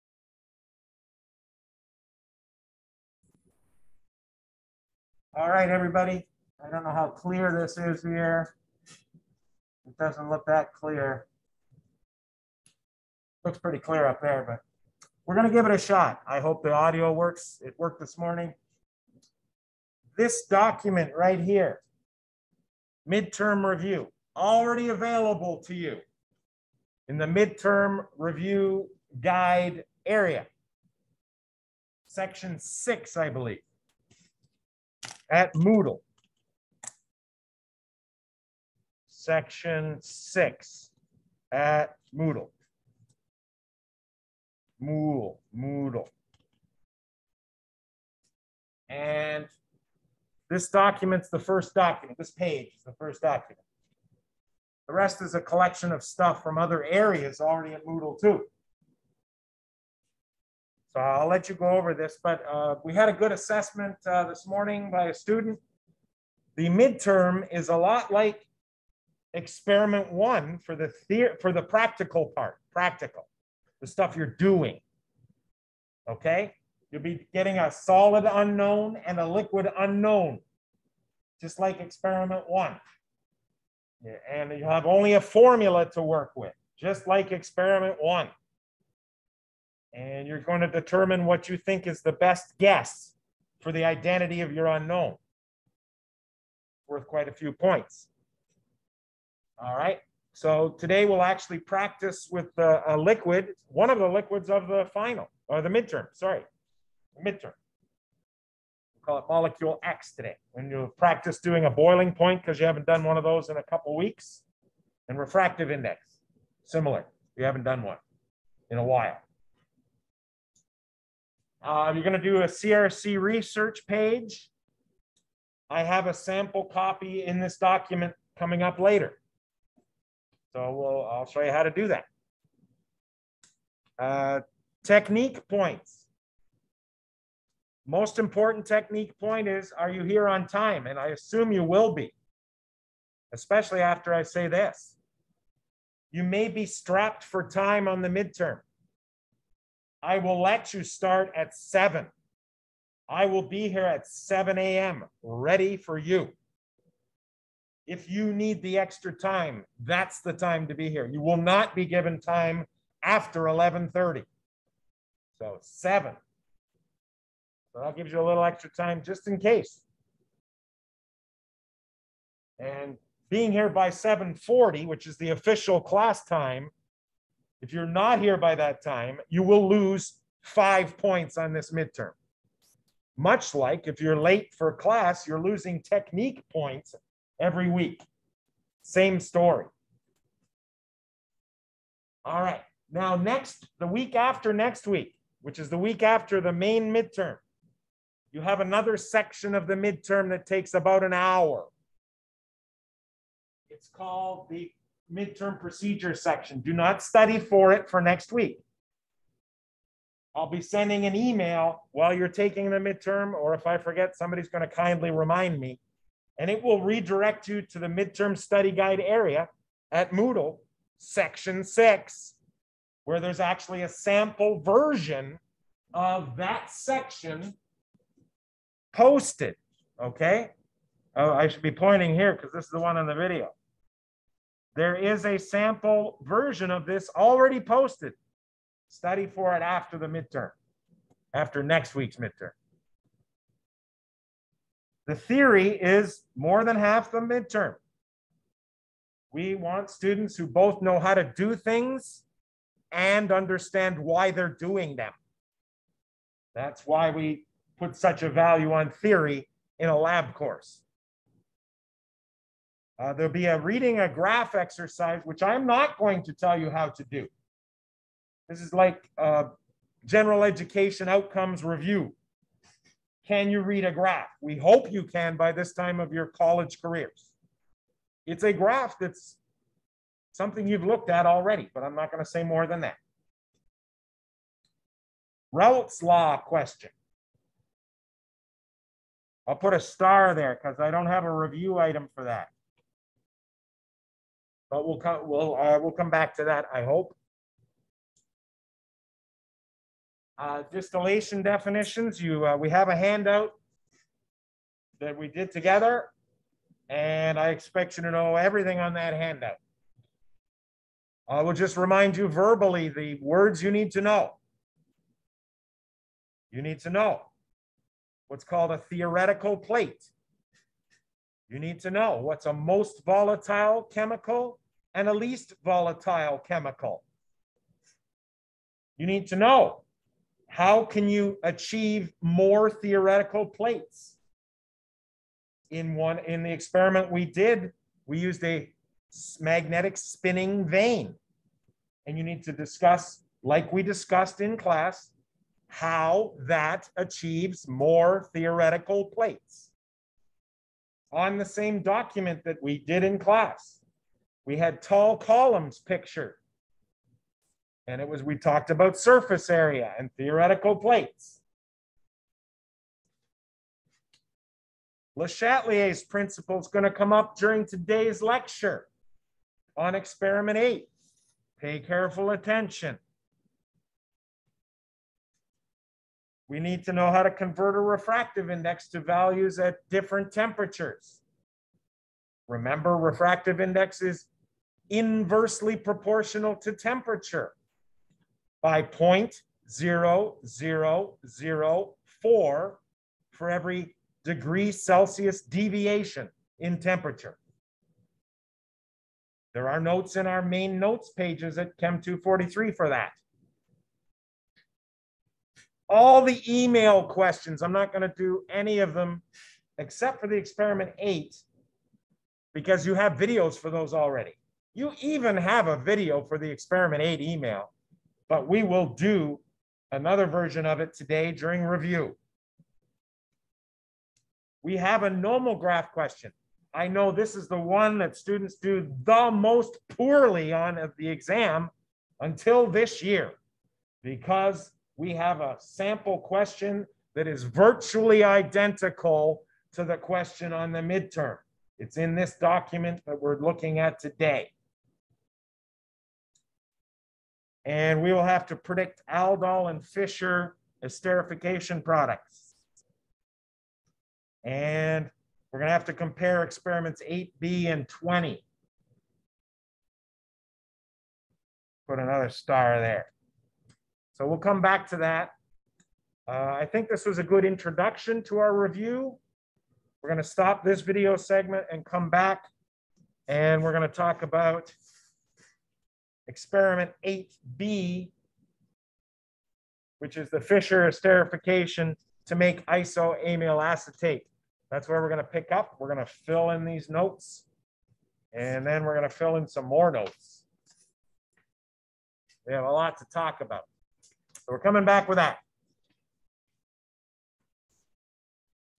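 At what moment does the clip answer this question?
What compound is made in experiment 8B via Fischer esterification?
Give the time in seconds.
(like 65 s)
482 s.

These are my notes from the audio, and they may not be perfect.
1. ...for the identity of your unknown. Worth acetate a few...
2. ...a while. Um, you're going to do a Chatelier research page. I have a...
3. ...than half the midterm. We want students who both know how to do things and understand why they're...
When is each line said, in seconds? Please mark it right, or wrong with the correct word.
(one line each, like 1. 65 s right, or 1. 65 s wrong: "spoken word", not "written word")
1. 93 s wrong: "quite", not "acetate"
2. 118 s wrong: "CRC", not "Chatelier"
3. 246 s right.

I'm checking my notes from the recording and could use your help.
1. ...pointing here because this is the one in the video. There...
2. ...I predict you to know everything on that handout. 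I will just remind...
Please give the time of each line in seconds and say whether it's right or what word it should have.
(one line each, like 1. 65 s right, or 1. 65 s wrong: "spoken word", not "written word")
1. 231 s right
2. 307 s wrong: "expect", not "predict".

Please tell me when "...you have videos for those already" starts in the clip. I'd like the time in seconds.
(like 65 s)
412 s.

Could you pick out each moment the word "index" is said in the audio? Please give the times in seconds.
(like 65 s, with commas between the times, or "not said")
115 s, 378 s, 383 s.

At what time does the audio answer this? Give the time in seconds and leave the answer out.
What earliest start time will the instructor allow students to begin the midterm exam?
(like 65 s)
154 s.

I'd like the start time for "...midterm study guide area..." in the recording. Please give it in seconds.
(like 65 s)
217 s.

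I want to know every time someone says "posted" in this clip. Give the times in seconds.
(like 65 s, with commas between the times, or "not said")
228 s, 237 s.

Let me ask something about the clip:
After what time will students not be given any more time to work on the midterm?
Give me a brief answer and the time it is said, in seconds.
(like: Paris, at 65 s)
11:30, at 163 s.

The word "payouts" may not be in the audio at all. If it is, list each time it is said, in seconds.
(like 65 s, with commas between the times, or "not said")
not said.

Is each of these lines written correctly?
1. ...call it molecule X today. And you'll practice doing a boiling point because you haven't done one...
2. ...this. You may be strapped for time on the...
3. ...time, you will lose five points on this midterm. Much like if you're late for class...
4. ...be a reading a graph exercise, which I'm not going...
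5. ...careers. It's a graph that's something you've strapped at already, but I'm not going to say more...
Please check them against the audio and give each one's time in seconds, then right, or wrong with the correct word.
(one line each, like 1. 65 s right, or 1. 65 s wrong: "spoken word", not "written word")
1. 109 s right
2. 144 s right
3. 178 s right
4. 263 s right
5. 276 s wrong: "looked", not "strapped".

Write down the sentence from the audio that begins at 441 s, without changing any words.
It's in this document that we're looking at today and we will have to predict aldol and Fischer esterification products.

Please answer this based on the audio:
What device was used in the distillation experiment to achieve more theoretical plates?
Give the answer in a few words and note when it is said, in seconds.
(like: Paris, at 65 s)
magnetic spinning vane, at 339 s.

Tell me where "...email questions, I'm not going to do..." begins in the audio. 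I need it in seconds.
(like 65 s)
406 s.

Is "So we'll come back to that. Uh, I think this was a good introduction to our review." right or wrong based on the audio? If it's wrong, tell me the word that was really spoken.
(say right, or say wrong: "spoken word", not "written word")
right.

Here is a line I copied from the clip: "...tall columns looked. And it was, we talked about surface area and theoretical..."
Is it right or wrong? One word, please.
wrong.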